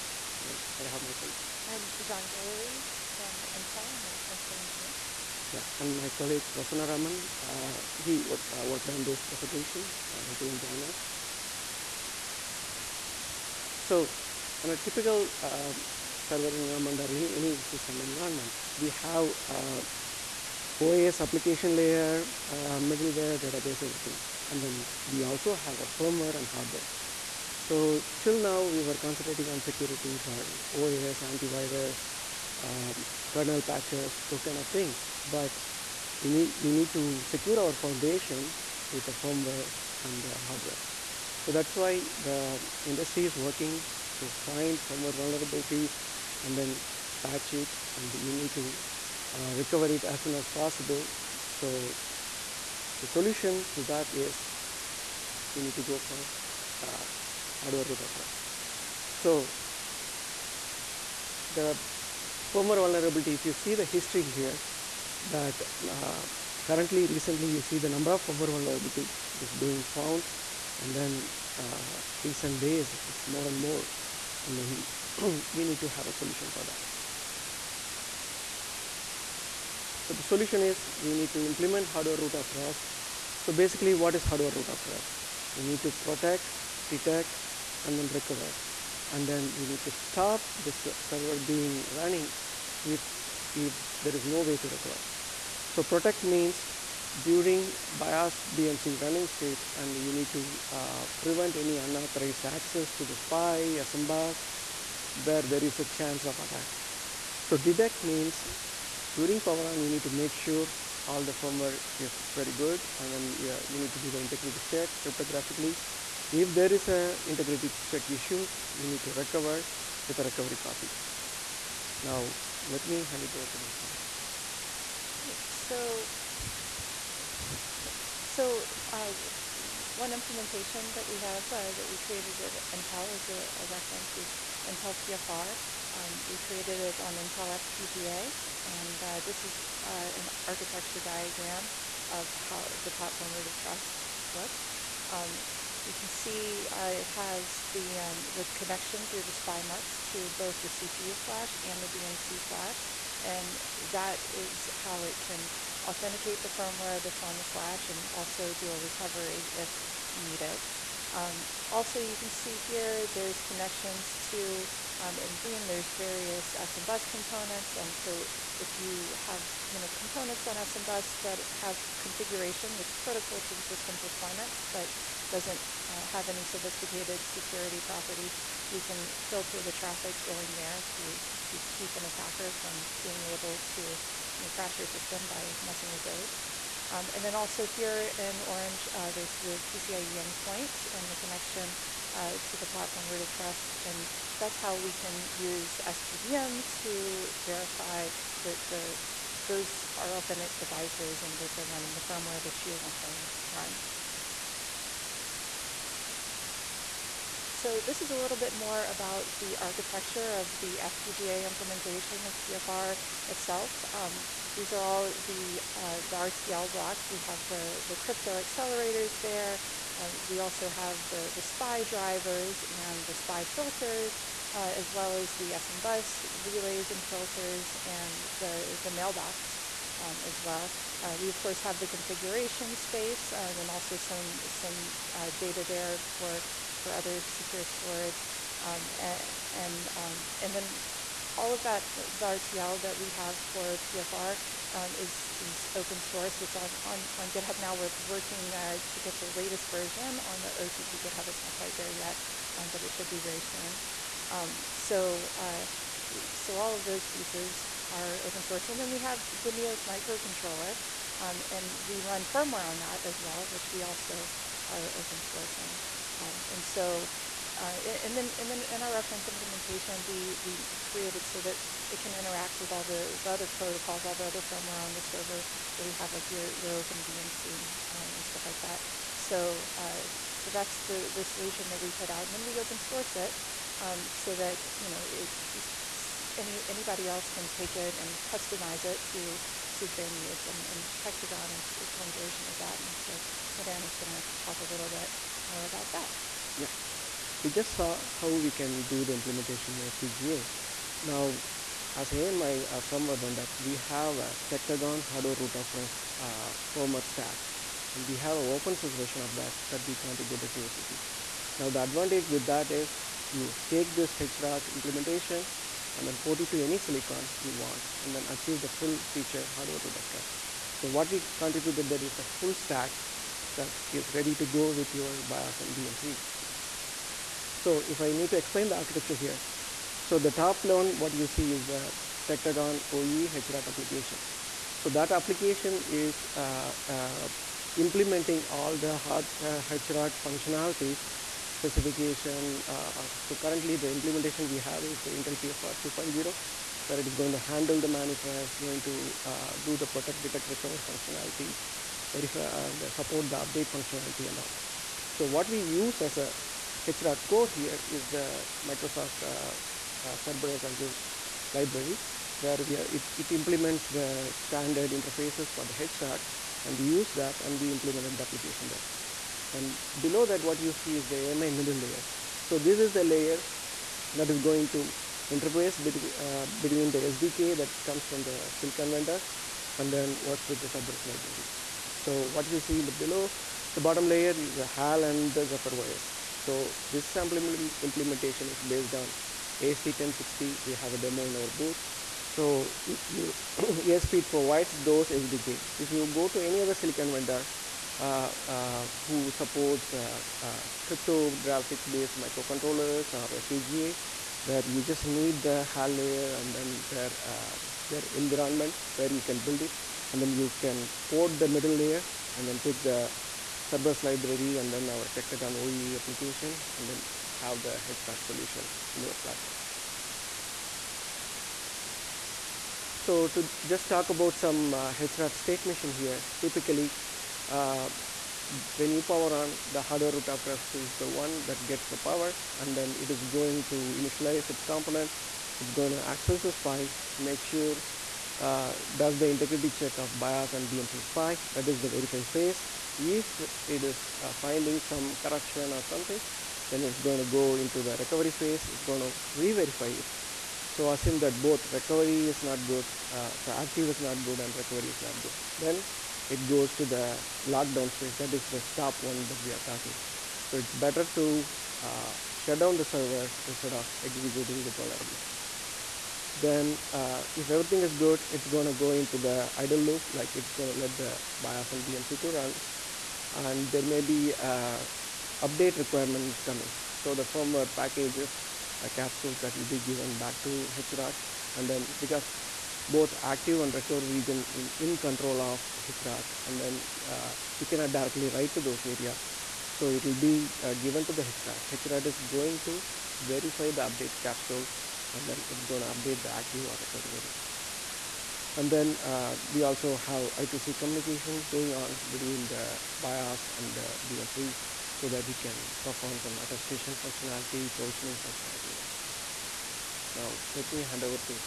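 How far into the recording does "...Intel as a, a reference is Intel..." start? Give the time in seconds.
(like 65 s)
132 s.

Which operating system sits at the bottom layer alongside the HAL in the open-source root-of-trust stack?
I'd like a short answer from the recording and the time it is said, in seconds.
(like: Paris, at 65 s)
Zephyr, at 385 s.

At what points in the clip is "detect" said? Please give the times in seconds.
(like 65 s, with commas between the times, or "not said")
86 s, 107 s, 350 s.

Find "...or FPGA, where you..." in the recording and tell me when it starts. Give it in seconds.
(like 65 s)
403 s.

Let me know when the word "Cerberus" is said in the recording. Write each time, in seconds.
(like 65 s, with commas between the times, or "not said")
360 s, 380 s, 413 s.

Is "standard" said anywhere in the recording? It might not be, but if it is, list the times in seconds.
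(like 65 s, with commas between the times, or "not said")
364 s.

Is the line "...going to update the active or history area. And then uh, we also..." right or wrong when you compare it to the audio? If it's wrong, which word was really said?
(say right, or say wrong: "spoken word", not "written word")
wrong: "recovery", not "history".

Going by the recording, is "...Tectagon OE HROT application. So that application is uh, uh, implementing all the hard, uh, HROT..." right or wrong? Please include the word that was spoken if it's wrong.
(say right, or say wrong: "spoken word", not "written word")
right.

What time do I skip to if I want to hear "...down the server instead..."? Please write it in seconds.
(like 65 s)
462 s.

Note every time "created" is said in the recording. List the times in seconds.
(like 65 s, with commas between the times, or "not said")
131 s, 136 s, 270 s.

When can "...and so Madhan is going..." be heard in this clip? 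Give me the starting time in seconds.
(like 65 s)
292 s.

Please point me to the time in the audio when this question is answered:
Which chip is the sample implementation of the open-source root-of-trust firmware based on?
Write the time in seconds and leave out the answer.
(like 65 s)
389 s.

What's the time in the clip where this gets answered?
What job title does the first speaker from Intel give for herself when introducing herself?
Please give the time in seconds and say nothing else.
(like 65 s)
4 s.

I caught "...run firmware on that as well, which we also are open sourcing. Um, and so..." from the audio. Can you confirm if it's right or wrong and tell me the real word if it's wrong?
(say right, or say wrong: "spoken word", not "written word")
right.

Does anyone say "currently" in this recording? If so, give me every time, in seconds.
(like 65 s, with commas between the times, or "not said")
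66 s, 343 s.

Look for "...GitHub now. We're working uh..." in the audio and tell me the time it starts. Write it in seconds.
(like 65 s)
247 s.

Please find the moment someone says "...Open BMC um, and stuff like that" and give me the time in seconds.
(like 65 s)
276 s.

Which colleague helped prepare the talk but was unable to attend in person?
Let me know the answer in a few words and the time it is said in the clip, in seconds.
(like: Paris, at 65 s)
Prasanna Raman, at 6 s.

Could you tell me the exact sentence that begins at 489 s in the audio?
So it will be uh, given to the HROT.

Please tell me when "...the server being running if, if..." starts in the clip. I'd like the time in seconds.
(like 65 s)
90 s.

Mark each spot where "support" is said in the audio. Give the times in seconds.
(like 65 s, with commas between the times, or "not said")
352 s, 399 s.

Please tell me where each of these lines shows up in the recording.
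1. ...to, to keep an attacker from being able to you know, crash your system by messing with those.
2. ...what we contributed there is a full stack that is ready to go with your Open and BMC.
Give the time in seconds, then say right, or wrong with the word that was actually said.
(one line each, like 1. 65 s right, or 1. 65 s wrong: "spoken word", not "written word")
1. 180 s right
2. 320 s wrong: "BIOS", not "Open".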